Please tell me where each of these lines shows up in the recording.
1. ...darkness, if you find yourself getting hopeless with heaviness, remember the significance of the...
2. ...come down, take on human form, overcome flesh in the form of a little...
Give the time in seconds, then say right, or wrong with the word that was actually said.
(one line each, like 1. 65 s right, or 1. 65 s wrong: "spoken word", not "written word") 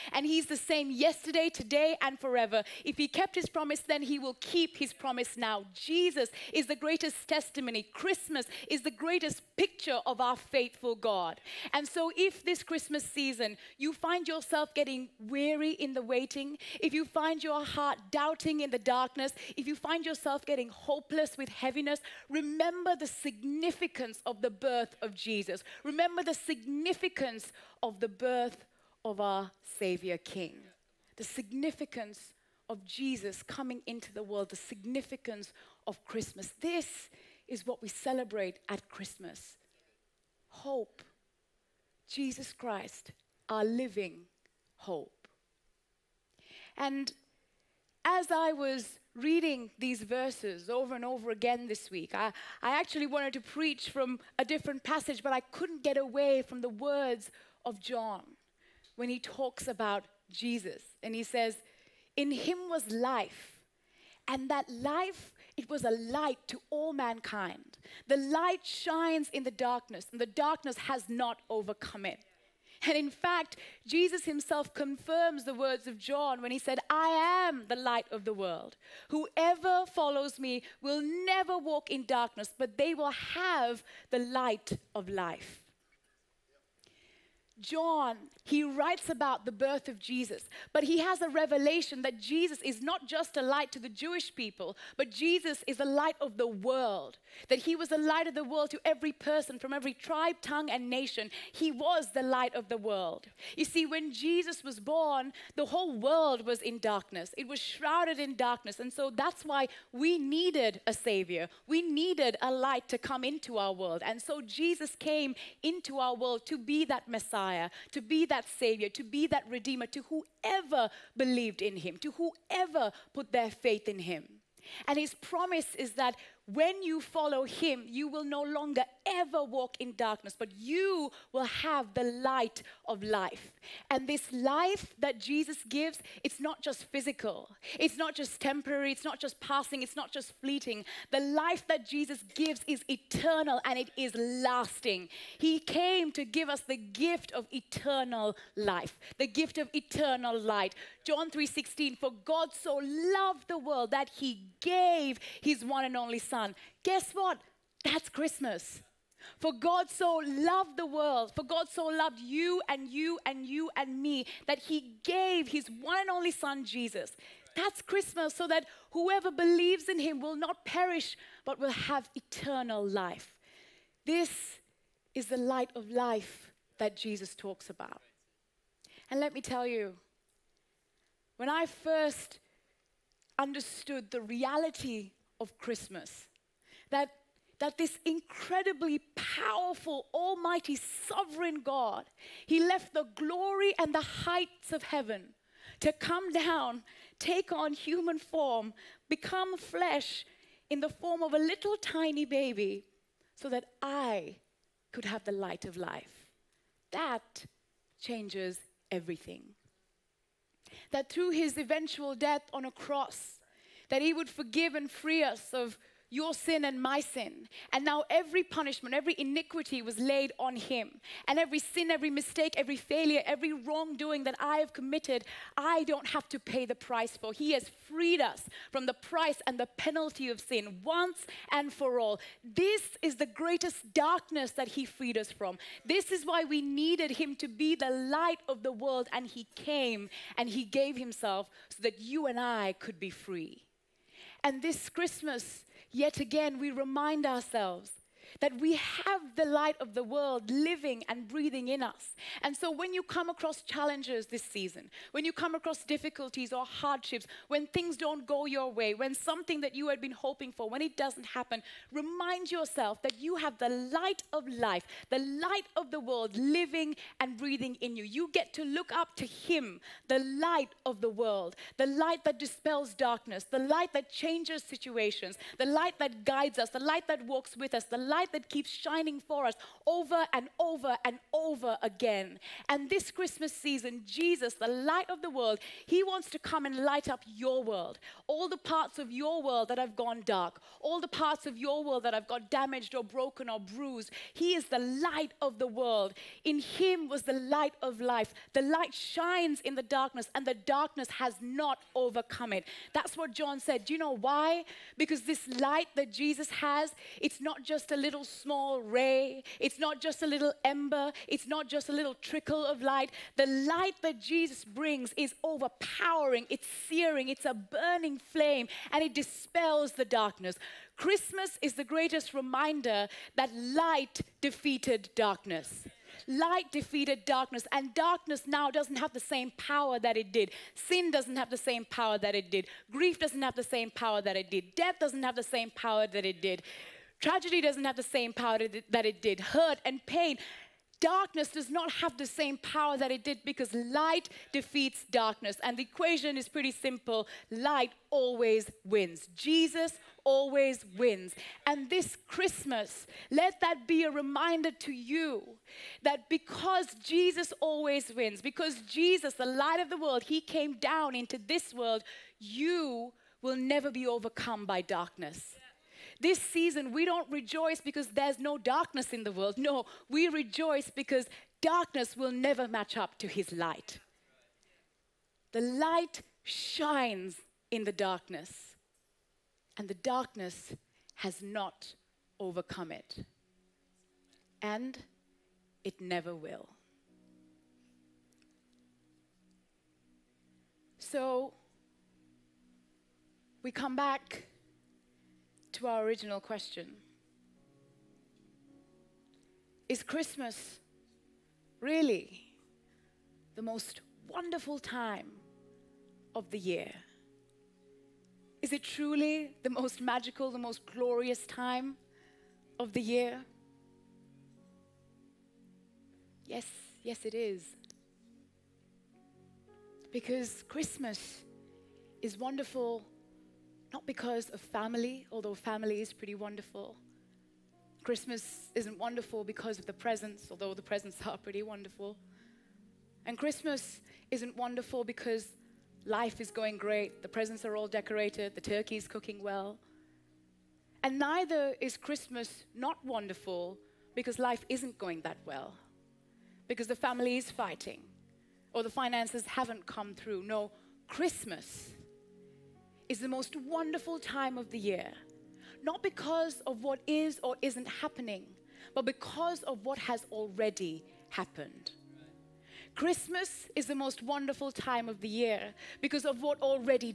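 1. 18 s right
2. 195 s wrong: "become", not "overcome".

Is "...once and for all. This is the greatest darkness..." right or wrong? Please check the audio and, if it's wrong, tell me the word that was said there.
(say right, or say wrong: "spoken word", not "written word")
right.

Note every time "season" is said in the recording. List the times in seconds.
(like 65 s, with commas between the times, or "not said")
13 s, 254 s, 283 s, 366 s.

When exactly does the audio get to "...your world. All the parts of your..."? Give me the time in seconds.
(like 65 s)
287 s.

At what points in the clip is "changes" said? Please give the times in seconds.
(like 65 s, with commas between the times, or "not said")
207 s, 274 s.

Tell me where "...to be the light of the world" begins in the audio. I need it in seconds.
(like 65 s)
237 s.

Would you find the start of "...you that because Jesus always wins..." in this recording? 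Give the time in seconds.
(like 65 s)
354 s.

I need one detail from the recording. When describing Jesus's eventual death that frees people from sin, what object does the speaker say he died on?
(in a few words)
a cross.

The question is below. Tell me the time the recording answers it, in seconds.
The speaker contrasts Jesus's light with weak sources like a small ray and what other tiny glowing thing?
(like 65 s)
310 s.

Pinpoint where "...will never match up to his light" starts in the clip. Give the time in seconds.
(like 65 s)
372 s.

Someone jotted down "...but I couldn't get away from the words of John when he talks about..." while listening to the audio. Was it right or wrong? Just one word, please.
right.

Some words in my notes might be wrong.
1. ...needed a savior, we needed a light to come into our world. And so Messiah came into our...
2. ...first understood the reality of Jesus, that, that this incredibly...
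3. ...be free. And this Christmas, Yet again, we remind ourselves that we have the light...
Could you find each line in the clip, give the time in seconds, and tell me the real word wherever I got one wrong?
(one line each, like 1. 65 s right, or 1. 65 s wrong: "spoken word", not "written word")
1. 110 s wrong: "Jesus", not "Messiah"
2. 181 s wrong: "Christmas", not "Jesus"
3. 242 s right.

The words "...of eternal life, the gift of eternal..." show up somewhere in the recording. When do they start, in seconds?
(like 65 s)
147 s.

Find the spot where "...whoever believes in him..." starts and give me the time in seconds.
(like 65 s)
168 s.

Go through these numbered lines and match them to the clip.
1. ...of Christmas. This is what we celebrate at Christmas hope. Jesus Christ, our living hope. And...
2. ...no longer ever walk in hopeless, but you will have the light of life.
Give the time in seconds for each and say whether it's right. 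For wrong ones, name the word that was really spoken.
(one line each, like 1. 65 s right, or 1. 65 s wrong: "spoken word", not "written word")
1. 35 s right
2. 128 s wrong: "darkness", not "hopeless".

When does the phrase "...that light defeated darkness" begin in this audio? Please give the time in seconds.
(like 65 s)
323 s.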